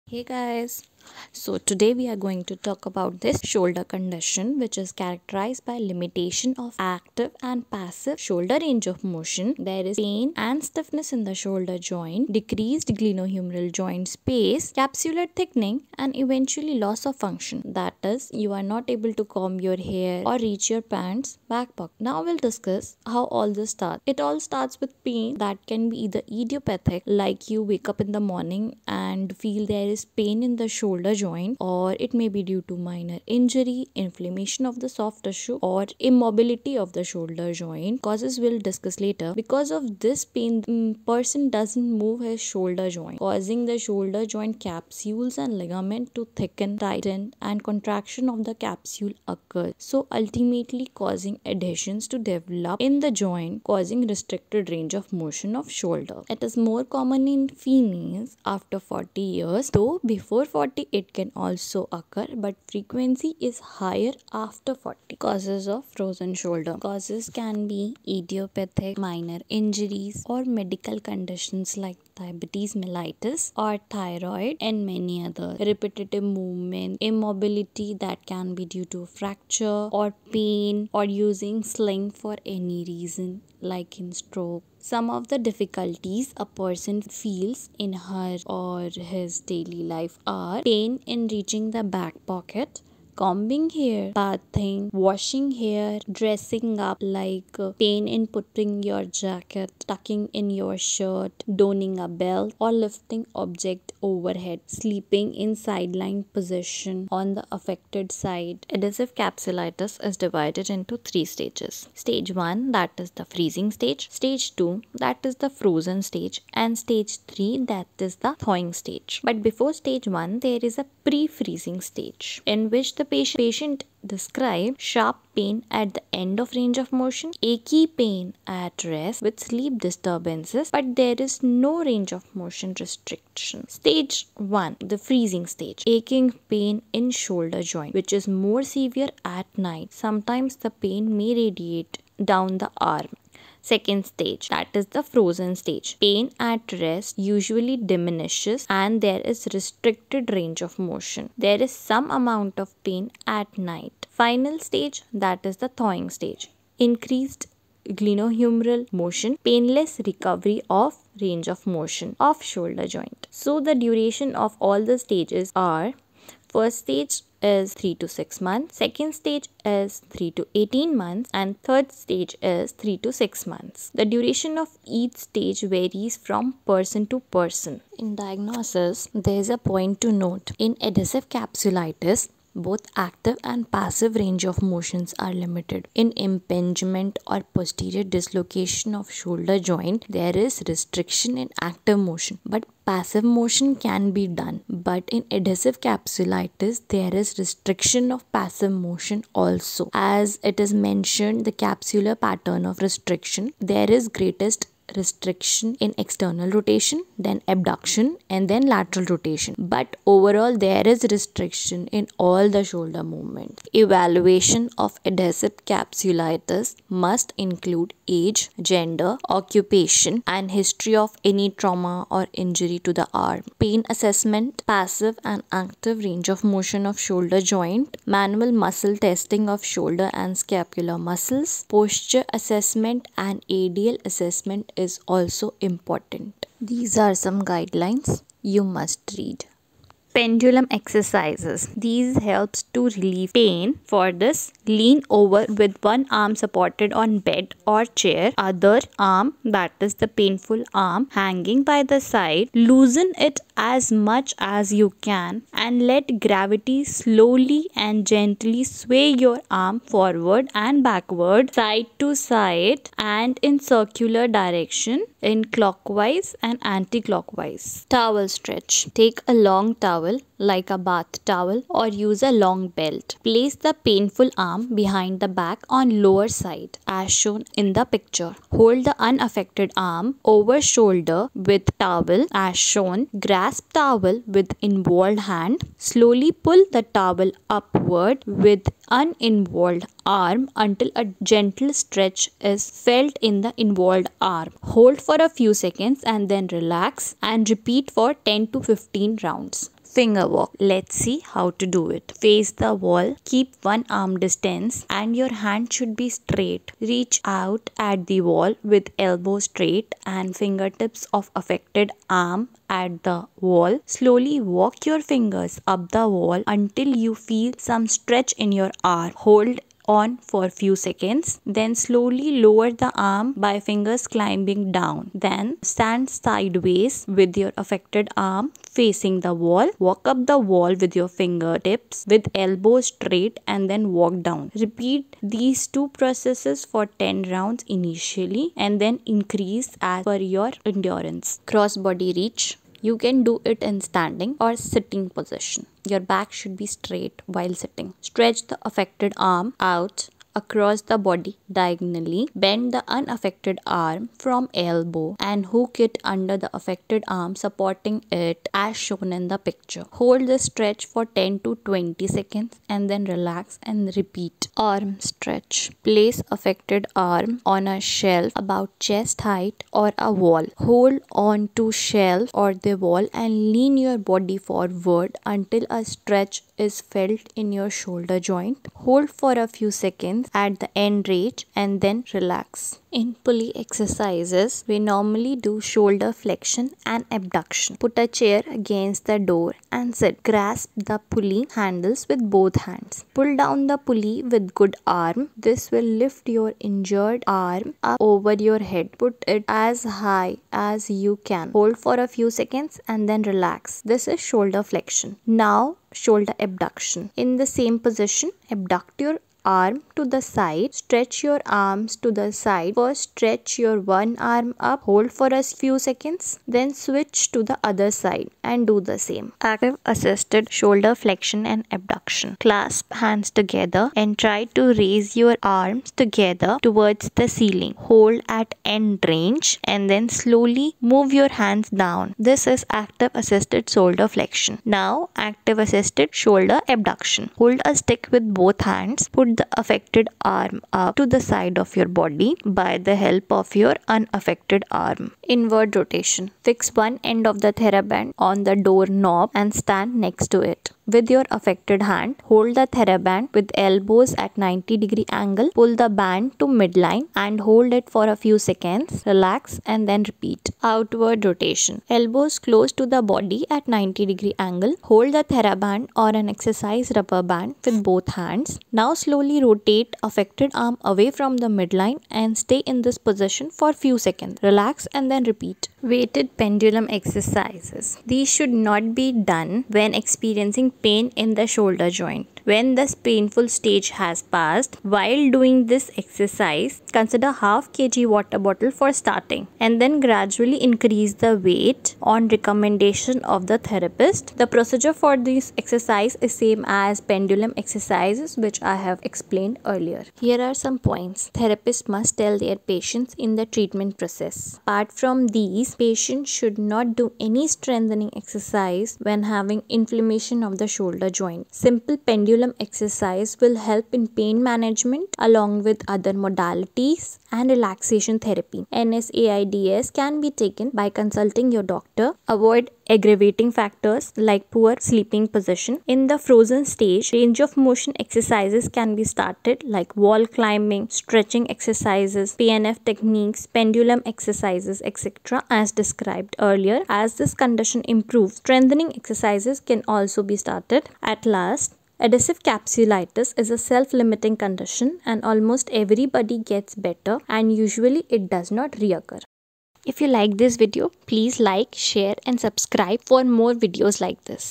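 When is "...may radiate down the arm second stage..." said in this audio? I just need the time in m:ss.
2:21.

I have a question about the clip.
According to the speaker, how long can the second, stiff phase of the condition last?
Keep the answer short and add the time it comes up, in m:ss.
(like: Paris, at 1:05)
3 to 18 months, at 2:50.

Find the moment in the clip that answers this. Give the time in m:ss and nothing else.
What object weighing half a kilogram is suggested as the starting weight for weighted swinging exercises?
8:08.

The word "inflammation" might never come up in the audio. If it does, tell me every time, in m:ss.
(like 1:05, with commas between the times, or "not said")
0:33, 8:29.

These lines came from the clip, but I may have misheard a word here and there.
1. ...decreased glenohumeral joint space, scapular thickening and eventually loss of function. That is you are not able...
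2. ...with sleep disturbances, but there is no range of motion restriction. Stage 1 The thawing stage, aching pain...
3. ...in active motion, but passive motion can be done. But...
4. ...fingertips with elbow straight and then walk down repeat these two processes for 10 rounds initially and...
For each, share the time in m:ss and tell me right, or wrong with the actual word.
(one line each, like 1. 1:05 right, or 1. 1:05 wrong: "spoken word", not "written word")
1. 0:12 wrong: "capsular", not "scapular"
2. 2:09 wrong: "freezing", not "thawing"
3. 3:11 right
4. 5:31 right.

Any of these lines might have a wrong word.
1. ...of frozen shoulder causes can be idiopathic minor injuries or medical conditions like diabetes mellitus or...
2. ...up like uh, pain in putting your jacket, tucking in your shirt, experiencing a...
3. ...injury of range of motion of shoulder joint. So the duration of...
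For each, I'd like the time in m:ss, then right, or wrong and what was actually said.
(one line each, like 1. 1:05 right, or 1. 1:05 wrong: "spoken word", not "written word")
1. 1:05 right
2. 1:36 wrong: "donning", not "experiencing"
3. 2:40 wrong: "recovery", not "injury".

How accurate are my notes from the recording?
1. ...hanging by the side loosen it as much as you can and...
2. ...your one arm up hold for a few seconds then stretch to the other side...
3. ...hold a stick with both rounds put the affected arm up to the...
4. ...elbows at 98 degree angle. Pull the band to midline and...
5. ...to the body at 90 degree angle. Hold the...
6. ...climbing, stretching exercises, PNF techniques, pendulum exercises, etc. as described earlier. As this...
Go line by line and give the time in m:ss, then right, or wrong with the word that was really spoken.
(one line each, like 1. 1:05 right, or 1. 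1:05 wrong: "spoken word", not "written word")
1. 4:11 right
2. 6:53 wrong: "switch", not "stretch"
3. 7:17 wrong: "hands", not "rounds"
4. 7:33 wrong: "90", not "98"
5. 7:42 right
6. 8:50 right.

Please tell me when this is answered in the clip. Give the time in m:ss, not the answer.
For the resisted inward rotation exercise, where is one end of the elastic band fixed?
7:28.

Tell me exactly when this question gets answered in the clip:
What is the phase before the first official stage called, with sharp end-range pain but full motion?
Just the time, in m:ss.
2:01.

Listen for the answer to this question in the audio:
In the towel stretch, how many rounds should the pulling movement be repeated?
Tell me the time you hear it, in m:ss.
4:58.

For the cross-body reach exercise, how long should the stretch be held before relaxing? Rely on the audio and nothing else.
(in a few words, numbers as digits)
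10 to 20 seconds.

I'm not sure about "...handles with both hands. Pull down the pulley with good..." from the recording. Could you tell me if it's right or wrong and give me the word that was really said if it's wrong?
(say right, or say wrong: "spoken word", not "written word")
right.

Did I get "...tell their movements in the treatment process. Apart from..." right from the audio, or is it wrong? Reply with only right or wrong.
wrong.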